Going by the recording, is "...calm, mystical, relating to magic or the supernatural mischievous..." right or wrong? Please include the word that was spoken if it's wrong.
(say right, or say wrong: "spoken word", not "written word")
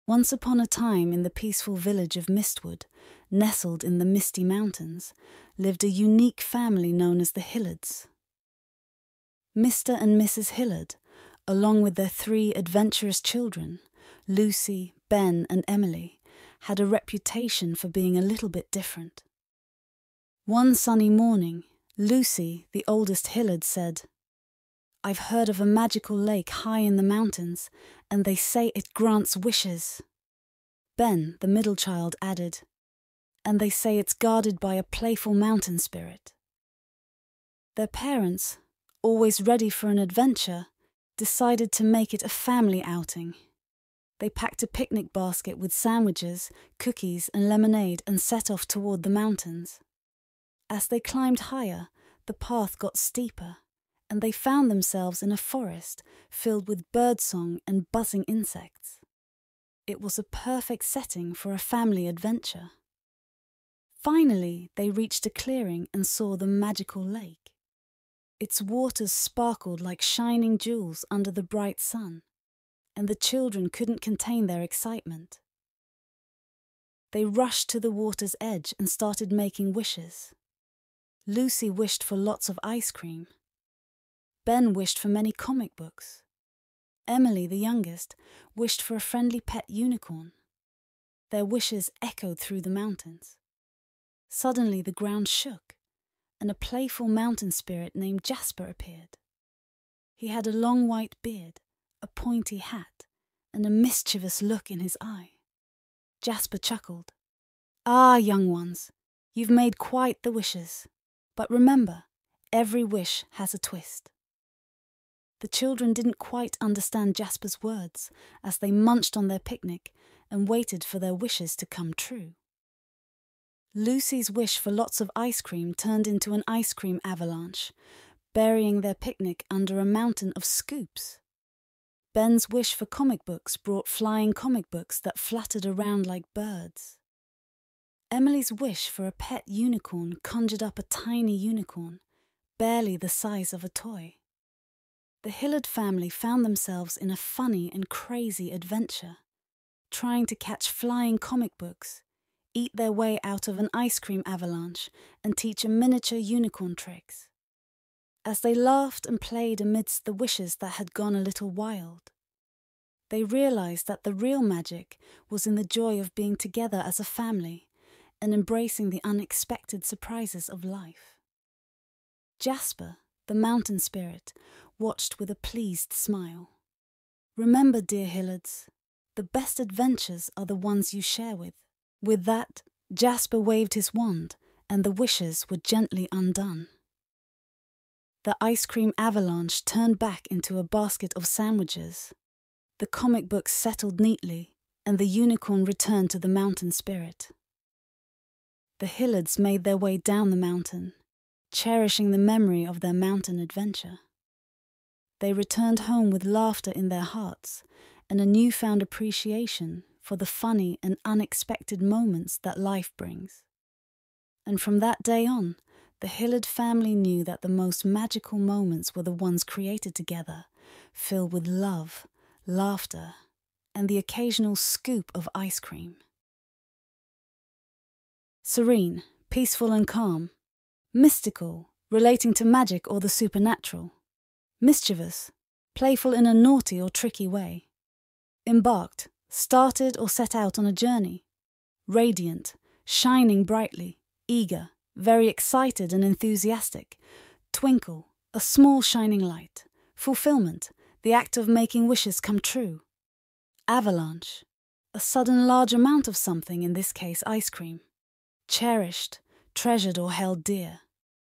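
right.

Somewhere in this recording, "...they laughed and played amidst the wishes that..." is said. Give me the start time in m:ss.
2:38.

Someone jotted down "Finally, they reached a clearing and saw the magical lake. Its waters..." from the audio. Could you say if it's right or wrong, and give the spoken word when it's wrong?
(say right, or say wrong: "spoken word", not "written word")
right.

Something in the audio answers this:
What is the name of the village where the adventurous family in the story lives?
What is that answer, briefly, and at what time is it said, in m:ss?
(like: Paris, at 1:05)
Mistwood, at 0:02.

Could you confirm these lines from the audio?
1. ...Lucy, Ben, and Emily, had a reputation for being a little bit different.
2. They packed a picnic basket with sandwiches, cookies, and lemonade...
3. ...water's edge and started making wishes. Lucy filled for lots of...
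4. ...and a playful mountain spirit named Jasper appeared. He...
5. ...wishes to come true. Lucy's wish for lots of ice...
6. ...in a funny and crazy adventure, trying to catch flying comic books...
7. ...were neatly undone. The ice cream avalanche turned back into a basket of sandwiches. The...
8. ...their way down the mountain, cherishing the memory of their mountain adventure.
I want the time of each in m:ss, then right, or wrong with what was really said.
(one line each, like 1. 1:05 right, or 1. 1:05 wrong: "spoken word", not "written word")
1. 0:14 right
2. 0:44 right
3. 1:17 wrong: "wished", not "filled"
4. 1:36 right
5. 2:01 right
6. 2:26 right
7. 3:05 wrong: "gently", not "neatly"
8. 3:19 right.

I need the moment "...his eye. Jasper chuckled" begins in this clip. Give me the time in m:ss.
1:44.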